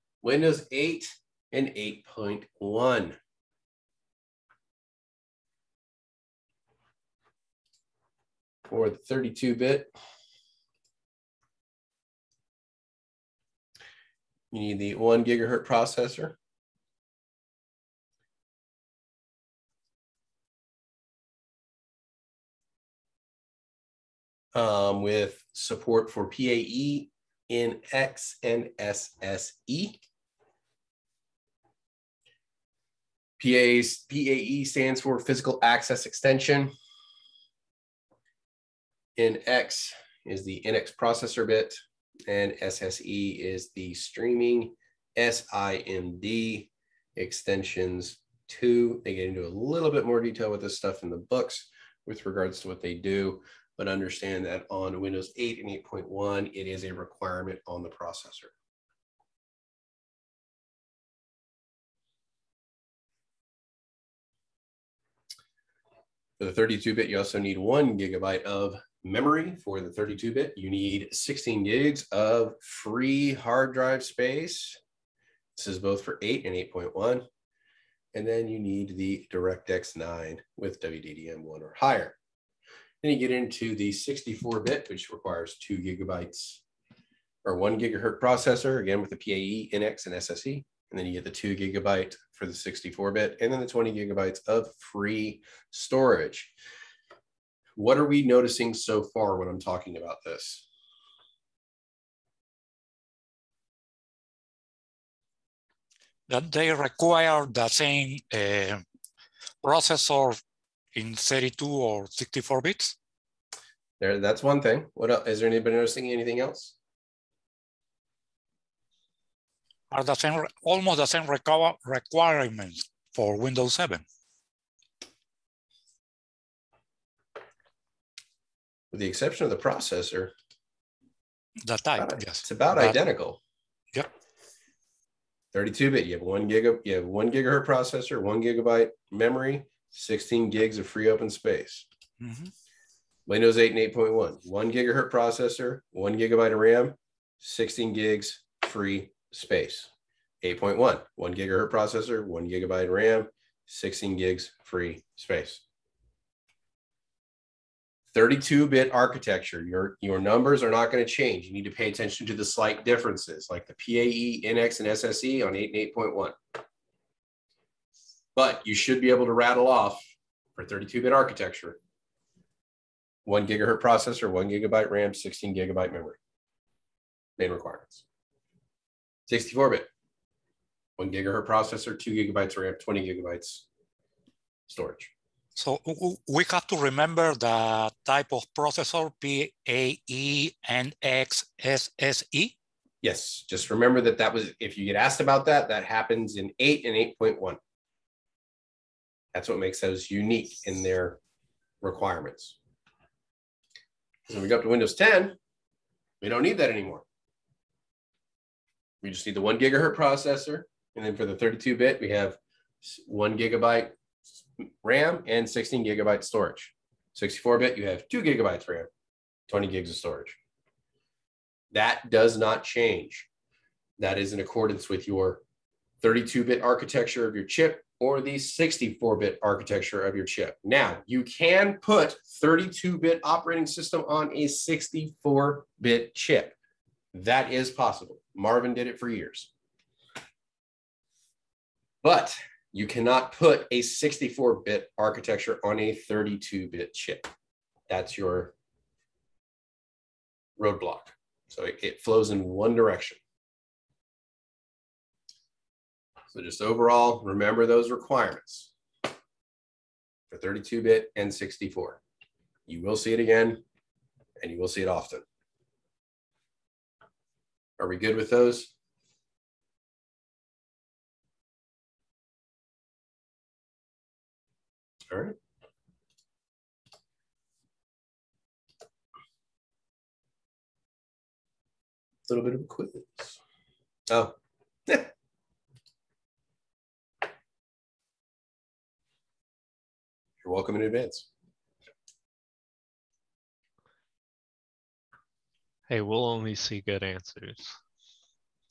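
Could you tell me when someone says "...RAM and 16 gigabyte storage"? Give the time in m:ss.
3:34.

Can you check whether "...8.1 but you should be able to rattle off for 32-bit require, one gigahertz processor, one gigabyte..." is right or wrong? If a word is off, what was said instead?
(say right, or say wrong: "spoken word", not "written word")
wrong: "architecture", not "require".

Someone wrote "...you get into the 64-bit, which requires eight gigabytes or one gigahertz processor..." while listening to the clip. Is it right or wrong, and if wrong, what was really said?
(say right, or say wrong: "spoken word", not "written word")
wrong: "two", not "eight".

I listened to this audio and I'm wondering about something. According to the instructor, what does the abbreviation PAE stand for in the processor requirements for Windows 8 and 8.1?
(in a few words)
physical access extension.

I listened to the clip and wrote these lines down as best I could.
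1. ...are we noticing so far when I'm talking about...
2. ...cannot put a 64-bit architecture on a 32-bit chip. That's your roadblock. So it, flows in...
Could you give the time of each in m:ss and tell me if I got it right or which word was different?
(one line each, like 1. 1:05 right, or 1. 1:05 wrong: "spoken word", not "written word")
1. 1:37 right
2. 4:02 right.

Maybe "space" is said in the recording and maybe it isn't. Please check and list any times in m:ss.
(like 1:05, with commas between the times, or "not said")
1:14, 2:21, 2:29, 2:35.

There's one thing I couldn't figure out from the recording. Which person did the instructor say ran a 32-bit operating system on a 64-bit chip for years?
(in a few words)
Marvin.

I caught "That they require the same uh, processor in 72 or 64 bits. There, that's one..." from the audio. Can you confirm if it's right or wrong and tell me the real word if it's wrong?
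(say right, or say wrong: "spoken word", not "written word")
wrong: "32", not "72".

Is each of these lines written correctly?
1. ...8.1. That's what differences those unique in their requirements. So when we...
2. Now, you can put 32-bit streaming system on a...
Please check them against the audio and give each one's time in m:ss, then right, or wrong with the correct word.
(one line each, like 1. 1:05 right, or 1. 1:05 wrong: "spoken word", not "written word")
1. 3:17 wrong: "makes", not "differences"
2. 3:50 wrong: "operating", not "streaming".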